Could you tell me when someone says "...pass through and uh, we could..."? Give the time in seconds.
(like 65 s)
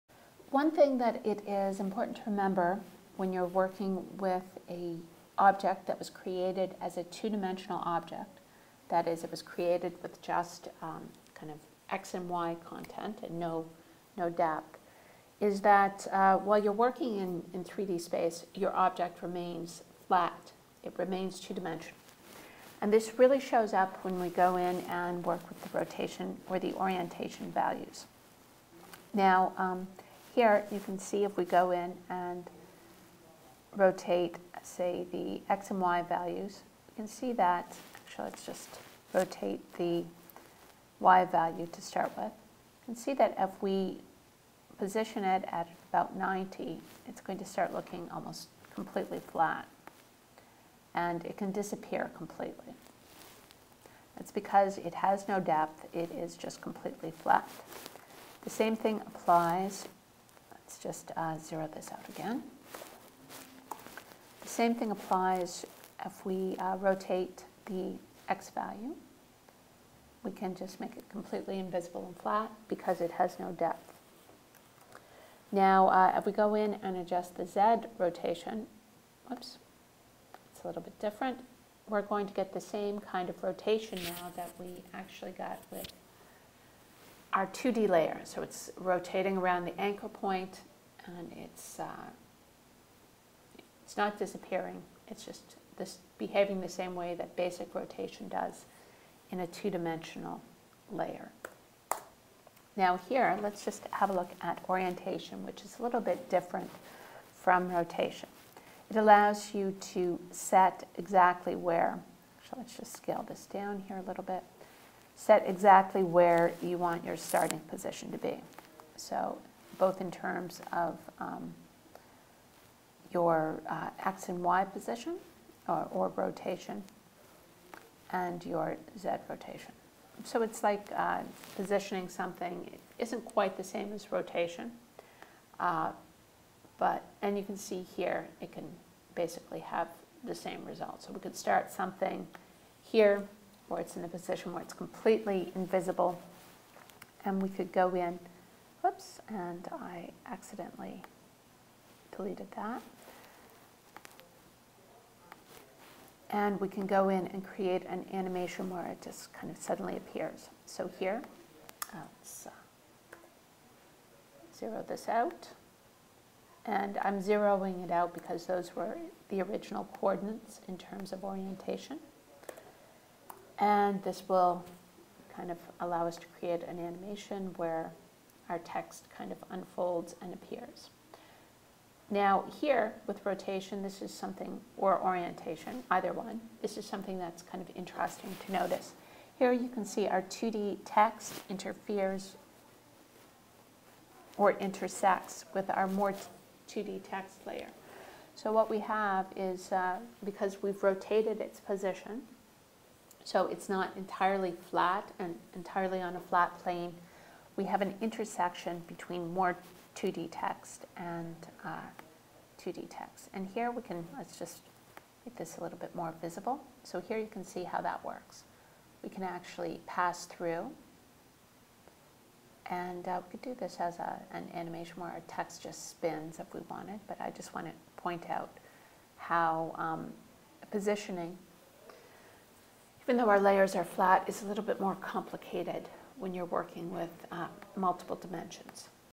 219 s.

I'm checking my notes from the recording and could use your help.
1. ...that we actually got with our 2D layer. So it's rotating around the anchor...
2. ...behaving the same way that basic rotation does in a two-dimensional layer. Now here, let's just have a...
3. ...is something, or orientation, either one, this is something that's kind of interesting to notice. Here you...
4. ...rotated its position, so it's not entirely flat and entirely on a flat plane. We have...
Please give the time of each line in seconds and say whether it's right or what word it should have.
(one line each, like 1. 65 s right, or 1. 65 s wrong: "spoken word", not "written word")
1. 84 s right
2. 96 s right
3. 184 s right
4. 200 s right.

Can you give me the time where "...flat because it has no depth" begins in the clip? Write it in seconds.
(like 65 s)
72 s.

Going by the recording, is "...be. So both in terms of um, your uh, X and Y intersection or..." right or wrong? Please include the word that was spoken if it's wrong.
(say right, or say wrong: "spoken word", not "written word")
wrong: "position", not "intersection".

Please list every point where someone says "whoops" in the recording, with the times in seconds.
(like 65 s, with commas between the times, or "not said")
79 s, 148 s.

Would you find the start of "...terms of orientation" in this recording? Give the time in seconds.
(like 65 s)
170 s.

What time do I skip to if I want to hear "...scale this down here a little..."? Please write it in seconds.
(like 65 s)
112 s.